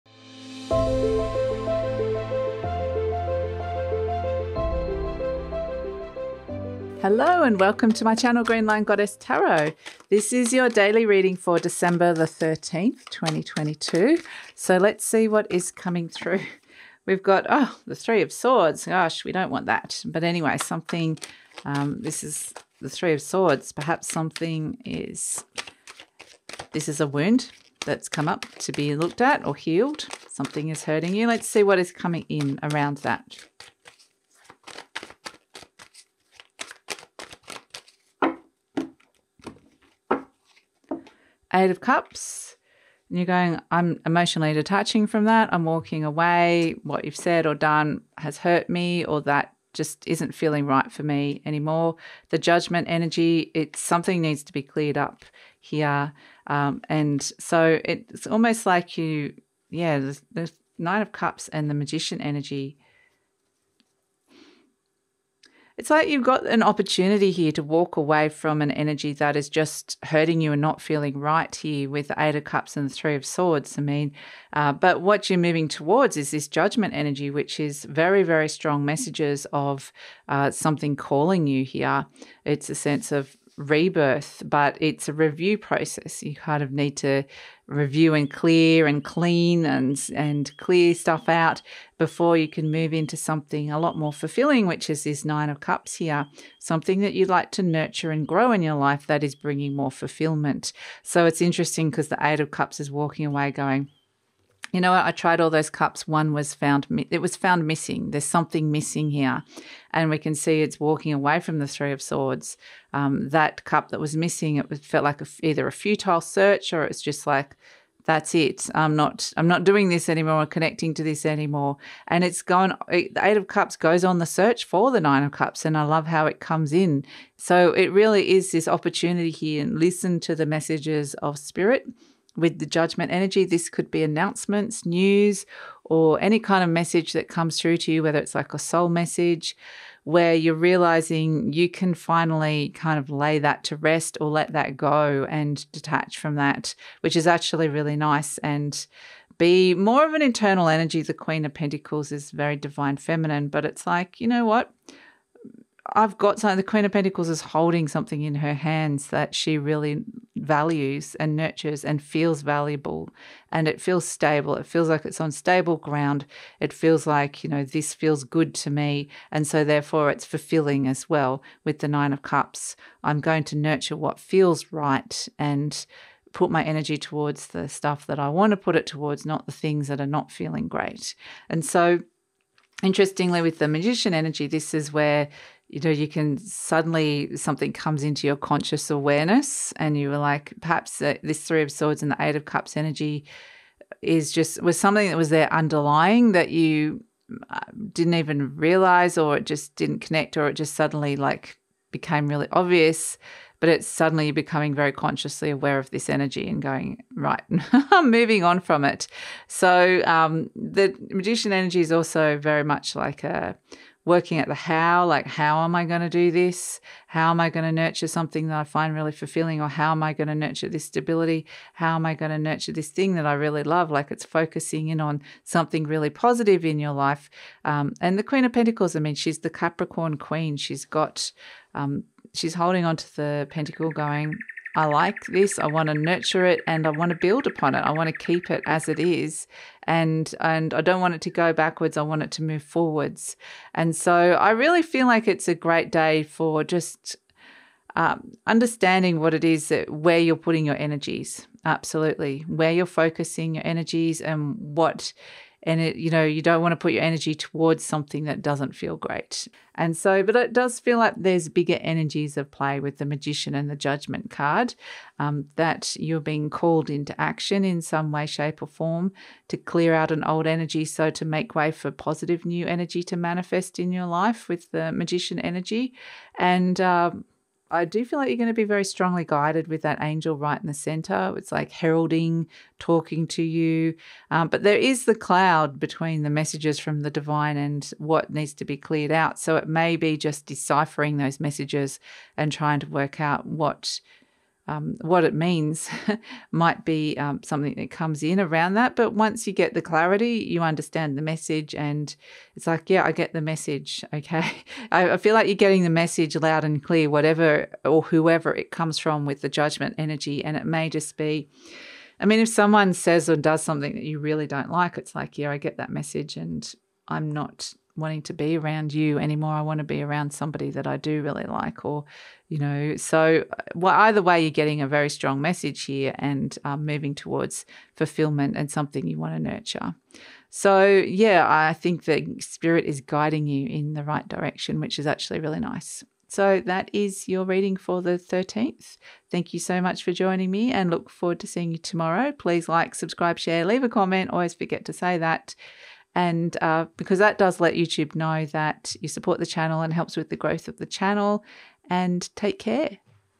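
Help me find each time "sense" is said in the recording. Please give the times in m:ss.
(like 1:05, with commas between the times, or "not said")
1:22.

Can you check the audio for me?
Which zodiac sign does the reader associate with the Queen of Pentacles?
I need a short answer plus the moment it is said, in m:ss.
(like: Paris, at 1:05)
Capricorn, at 3:49.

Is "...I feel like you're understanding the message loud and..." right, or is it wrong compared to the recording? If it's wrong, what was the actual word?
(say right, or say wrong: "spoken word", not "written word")
wrong: "getting", not "understanding".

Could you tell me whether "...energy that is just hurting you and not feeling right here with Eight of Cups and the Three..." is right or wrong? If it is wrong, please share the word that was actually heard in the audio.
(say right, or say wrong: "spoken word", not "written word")
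right.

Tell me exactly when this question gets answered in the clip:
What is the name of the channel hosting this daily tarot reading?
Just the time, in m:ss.
0:08.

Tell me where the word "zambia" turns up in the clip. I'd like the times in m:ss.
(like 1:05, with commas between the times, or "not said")
not said.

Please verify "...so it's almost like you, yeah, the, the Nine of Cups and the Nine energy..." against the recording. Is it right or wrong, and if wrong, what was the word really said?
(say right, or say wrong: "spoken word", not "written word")
wrong: "Magician", not "Nine".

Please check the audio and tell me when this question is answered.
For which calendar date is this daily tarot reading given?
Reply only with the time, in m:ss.
0:11.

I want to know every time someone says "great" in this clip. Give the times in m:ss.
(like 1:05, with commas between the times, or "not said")
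3:00, 4:05, 4:18.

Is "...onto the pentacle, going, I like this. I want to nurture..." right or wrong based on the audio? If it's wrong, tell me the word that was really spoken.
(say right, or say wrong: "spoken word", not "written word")
right.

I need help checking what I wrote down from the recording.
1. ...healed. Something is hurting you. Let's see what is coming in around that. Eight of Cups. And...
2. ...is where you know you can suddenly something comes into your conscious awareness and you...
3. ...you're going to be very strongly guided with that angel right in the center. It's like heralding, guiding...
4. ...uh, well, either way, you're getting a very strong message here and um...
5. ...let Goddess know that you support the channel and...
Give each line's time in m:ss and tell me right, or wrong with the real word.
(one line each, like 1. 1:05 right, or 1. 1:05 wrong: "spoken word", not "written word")
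1. 0:29 right
2. 3:04 right
3. 4:38 wrong: "talking", not "guiding"
4. 5:23 right
5. 5:47 wrong: "YouTube", not "Goddess".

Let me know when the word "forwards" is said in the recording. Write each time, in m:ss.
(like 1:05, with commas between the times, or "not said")
4:02, 5:41.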